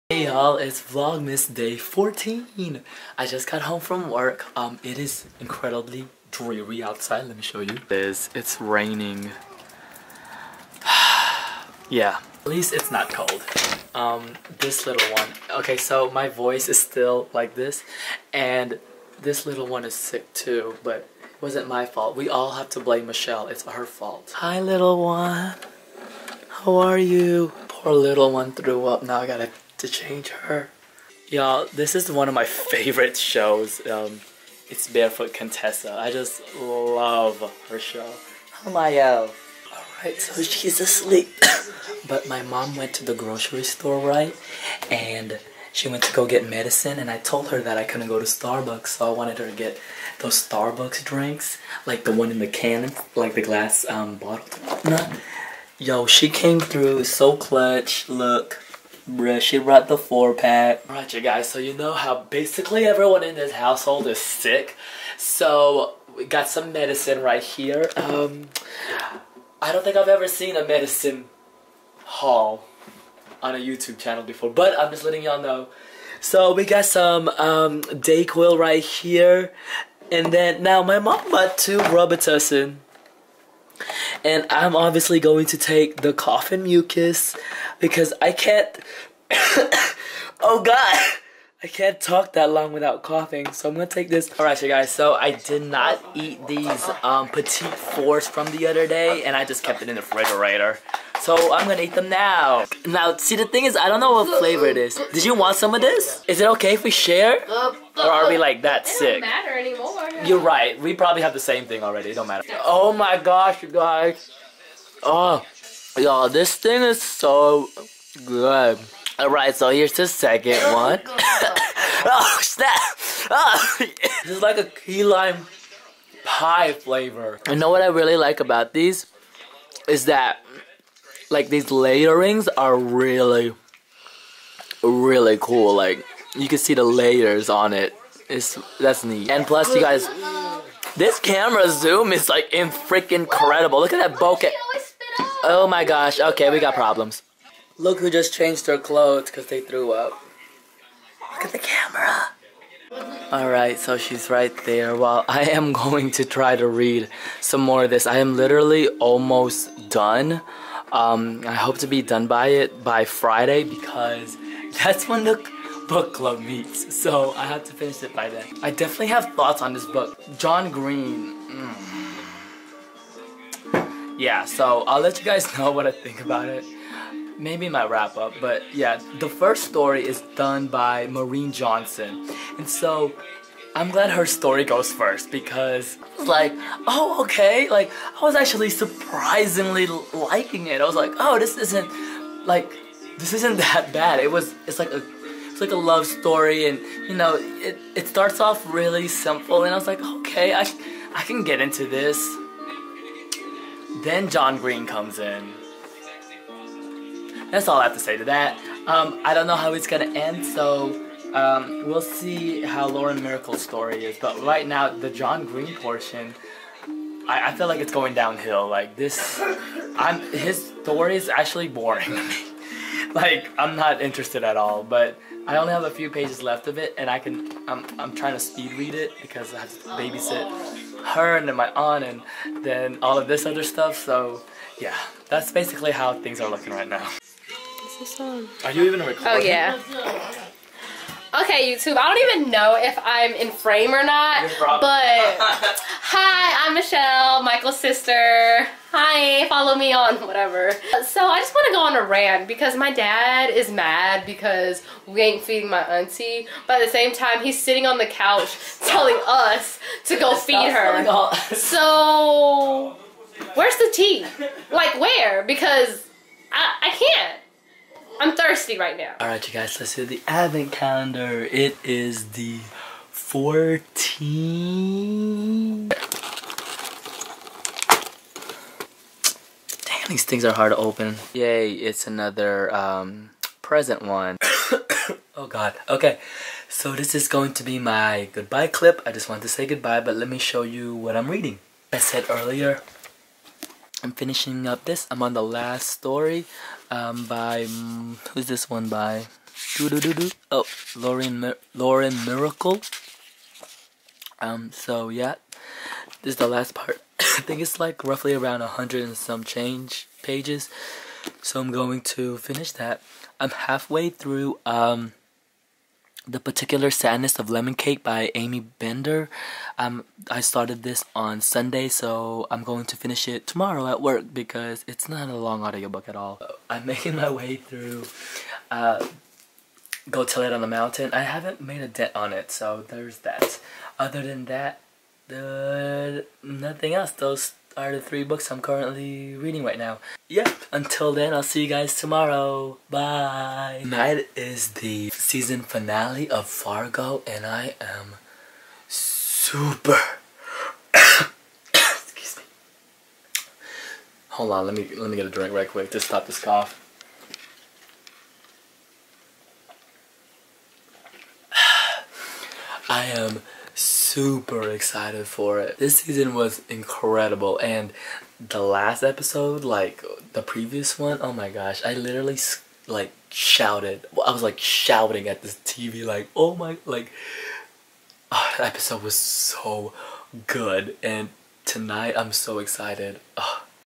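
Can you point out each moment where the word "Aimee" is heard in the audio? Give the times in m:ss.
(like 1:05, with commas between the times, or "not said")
5:18.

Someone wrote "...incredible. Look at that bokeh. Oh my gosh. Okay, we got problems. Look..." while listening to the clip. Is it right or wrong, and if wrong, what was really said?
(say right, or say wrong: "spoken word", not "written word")
right.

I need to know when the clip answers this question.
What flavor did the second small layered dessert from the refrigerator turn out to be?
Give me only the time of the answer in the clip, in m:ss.
2:04.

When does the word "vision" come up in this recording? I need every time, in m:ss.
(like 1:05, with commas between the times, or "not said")
not said.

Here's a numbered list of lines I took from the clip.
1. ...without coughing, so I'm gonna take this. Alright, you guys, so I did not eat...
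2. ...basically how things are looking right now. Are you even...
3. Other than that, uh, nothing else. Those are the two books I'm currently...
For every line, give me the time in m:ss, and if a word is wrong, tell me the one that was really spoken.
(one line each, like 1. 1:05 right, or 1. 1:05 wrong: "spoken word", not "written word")
1. 1:32 right
2. 3:55 right
3. 5:33 wrong: "three", not "two".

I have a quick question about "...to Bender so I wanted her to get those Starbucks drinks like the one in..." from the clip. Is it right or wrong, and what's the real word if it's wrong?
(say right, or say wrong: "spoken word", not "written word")
wrong: "Starbucks", not "Bender".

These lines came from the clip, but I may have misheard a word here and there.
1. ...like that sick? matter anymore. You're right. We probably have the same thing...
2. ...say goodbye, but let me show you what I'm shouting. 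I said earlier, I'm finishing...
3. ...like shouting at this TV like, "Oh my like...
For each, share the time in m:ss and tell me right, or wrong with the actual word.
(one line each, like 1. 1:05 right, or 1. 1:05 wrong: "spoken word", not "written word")
1. 1:48 right
2. 4:49 wrong: "reading", not "shouting"
3. 6:14 right.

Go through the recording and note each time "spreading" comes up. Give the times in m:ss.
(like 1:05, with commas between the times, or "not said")
not said.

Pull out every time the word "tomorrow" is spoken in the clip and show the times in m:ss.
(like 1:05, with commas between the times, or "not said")
5:23, 5:41.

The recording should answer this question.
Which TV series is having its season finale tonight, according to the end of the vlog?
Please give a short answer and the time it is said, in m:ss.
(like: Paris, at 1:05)
Fargo, at 5:46.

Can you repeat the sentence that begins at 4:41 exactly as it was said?
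Yay, it's another um, present one.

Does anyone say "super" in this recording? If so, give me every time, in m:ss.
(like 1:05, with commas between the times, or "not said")
5:48, 6:03.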